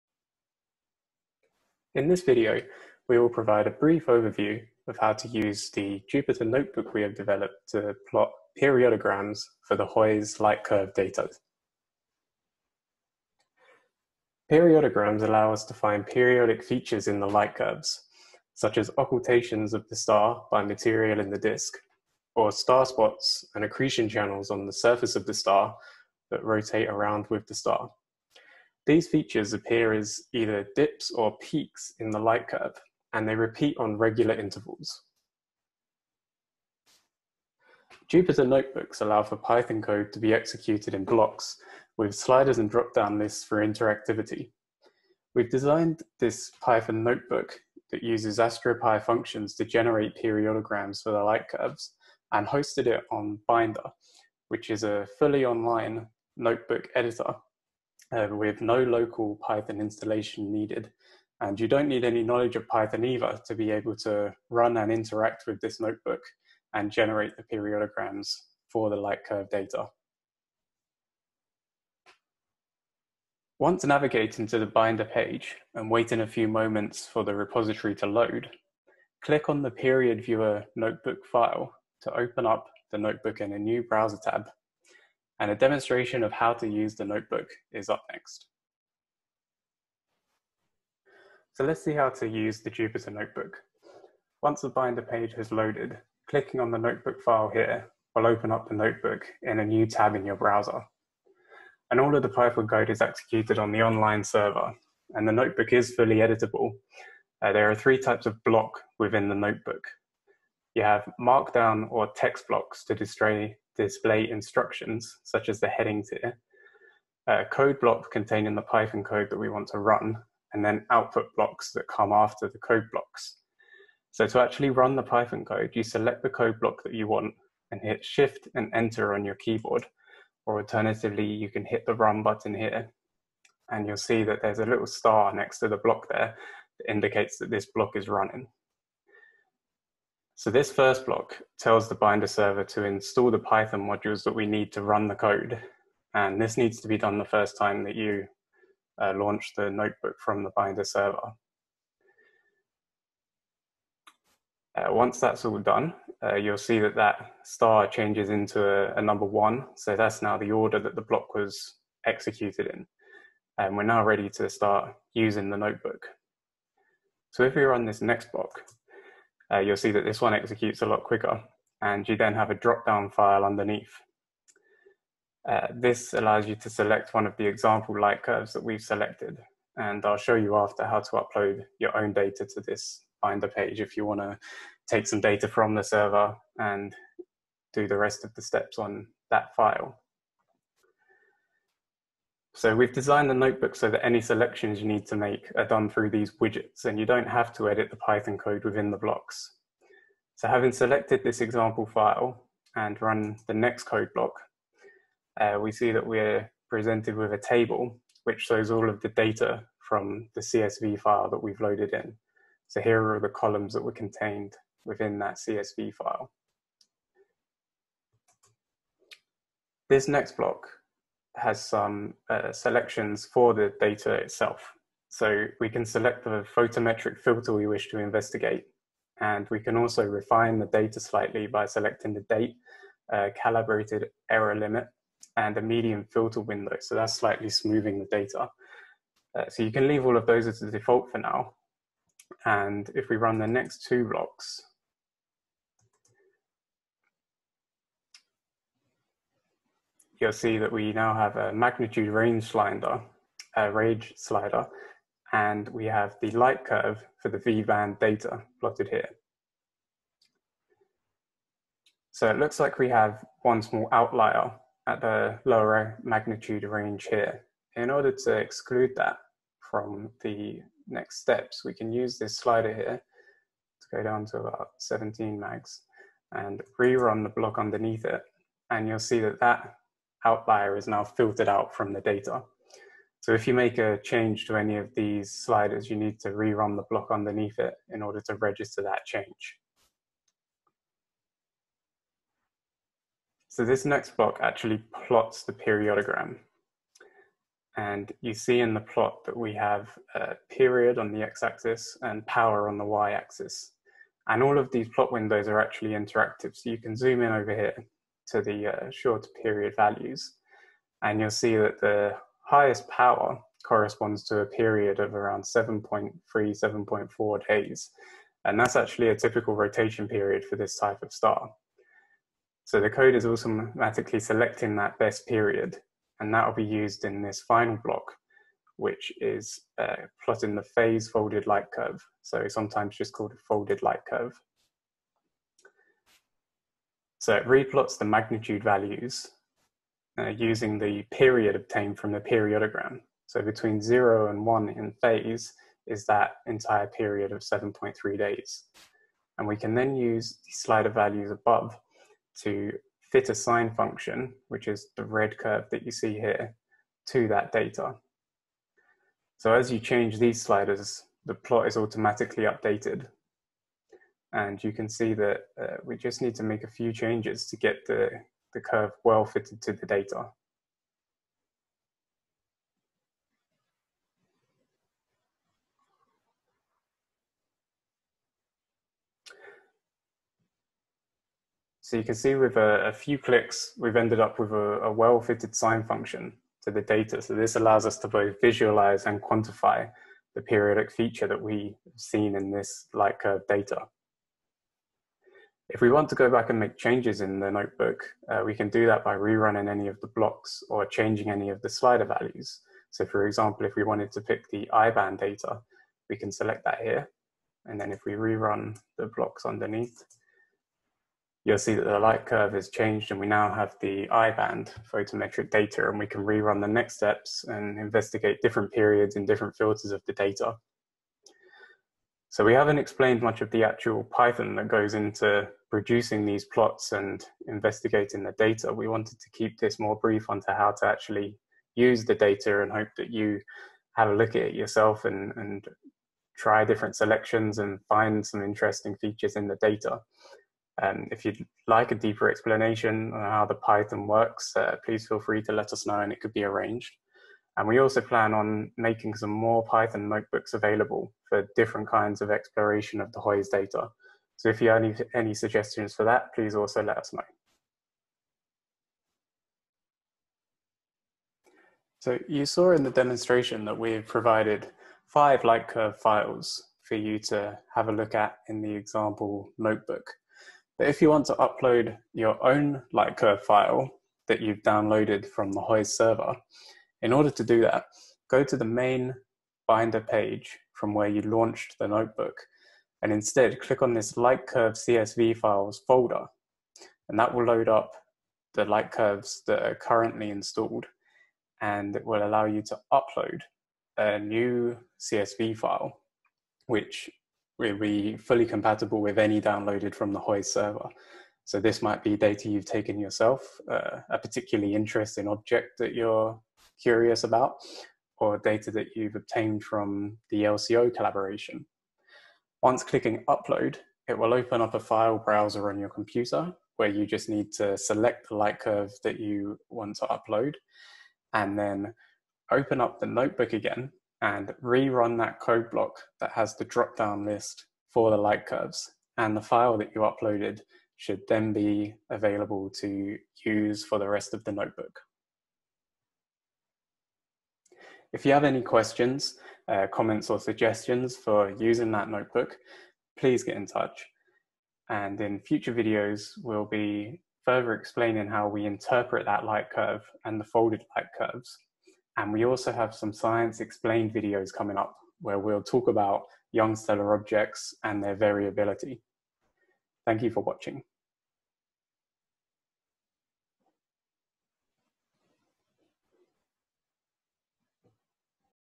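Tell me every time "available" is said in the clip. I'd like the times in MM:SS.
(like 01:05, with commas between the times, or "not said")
07:30, 08:52.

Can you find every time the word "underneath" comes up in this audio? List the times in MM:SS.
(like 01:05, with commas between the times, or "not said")
02:53, 04:37, 04:47, 06:49.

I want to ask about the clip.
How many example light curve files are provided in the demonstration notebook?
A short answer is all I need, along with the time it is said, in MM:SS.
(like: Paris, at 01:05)
5, at 07:45.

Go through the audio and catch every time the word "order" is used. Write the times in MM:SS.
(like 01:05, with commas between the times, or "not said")
02:40, 04:27, 04:48, 07:57.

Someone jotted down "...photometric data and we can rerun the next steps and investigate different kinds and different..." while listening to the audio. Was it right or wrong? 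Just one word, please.
wrong.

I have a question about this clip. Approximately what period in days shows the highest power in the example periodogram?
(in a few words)
7.3 to 7.4 days.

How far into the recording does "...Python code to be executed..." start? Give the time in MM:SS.
00:39.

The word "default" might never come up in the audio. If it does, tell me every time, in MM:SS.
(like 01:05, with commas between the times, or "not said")
04:00.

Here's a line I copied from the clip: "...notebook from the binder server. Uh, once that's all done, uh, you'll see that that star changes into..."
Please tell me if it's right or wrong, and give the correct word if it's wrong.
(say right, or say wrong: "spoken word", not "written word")
right.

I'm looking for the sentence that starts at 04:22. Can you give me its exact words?
So it looks like we have one small outlier at the lower magnitude range here.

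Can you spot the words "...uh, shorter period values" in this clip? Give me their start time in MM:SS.
05:08.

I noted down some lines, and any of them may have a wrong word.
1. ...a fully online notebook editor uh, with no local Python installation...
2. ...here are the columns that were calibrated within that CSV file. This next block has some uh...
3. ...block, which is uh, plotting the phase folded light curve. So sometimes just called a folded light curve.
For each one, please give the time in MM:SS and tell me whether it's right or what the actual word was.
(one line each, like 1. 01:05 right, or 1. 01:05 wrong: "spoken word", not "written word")
1. 00:54 right
2. 03:32 wrong: "contained", not "calibrated"
3. 05:27 right.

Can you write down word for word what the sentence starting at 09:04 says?
And in future videos, we'll be further explaining how we interpret that light curve and the folded light curves.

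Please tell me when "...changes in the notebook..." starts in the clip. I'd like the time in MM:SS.
06:36.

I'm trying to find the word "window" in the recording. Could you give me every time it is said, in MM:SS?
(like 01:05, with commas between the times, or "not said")
03:56, 05:05.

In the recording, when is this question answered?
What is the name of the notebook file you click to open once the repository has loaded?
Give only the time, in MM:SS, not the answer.
01:19.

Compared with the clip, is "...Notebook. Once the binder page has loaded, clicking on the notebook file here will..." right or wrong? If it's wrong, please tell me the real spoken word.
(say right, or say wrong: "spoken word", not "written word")
right.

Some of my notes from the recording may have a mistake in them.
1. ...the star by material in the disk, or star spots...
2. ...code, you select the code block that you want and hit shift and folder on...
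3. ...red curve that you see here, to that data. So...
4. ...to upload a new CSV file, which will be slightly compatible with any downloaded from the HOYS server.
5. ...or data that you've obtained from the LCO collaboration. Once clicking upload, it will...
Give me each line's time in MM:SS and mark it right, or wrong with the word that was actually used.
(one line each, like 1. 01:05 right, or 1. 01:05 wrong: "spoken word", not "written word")
1. 00:19 right
2. 02:05 wrong: "enter", not "folder"
3. 05:55 right
4. 08:12 wrong: "fully", not "slightly"
5. 08:28 right.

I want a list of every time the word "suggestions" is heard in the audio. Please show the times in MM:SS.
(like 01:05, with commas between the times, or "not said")
07:35, 09:00.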